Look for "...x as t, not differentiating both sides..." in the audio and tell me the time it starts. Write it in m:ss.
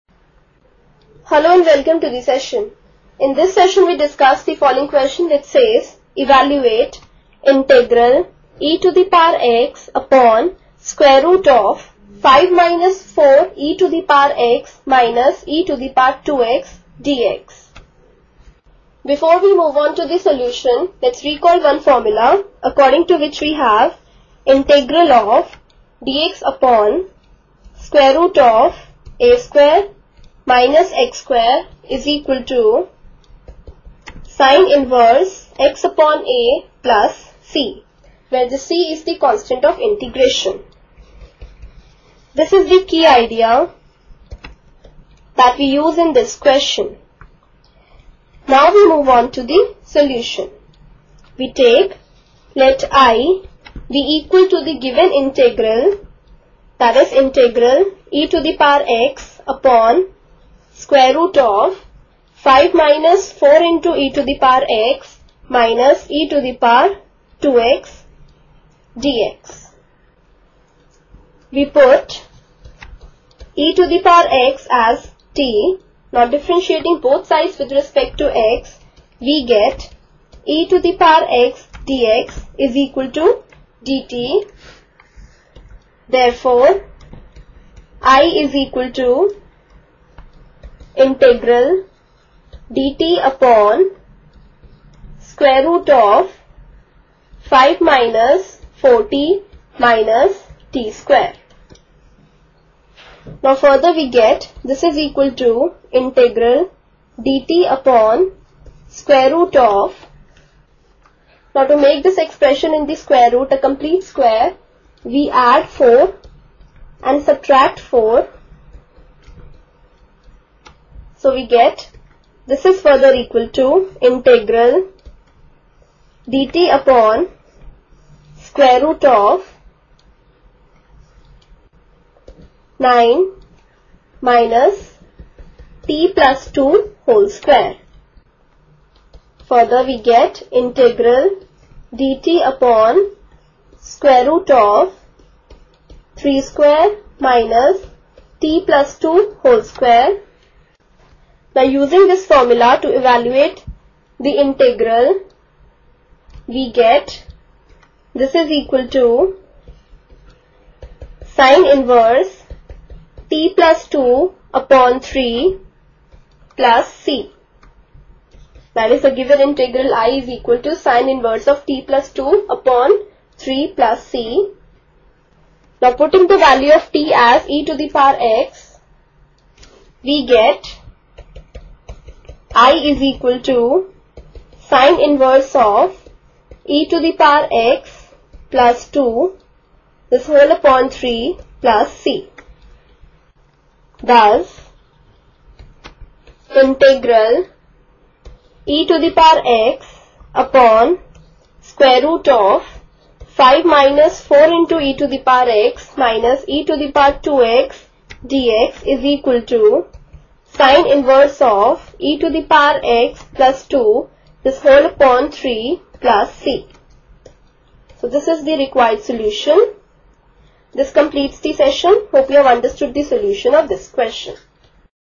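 1:14.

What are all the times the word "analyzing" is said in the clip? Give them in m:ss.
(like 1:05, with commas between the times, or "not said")
not said.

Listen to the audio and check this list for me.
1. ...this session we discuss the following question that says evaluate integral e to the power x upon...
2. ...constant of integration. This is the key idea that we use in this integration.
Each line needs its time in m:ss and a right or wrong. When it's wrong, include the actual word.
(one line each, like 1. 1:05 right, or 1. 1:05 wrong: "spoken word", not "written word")
1. 0:03 right
2. 0:39 wrong: "question", not "integration".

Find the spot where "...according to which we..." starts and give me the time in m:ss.
0:22.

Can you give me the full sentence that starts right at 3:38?
So this is the required solution.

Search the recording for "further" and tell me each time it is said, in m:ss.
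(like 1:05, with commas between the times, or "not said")
1:43, 2:02, 2:19.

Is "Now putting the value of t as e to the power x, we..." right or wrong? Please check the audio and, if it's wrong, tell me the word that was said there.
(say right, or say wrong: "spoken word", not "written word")
right.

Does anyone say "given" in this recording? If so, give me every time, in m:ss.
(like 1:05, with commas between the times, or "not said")
0:54, 2:49.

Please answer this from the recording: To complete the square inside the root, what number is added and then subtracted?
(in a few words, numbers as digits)
4.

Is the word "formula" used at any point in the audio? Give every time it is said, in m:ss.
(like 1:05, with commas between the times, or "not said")
0:21, 2:32.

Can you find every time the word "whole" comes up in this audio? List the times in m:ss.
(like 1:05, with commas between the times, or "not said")
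2:17, 2:29, 3:10, 3:34.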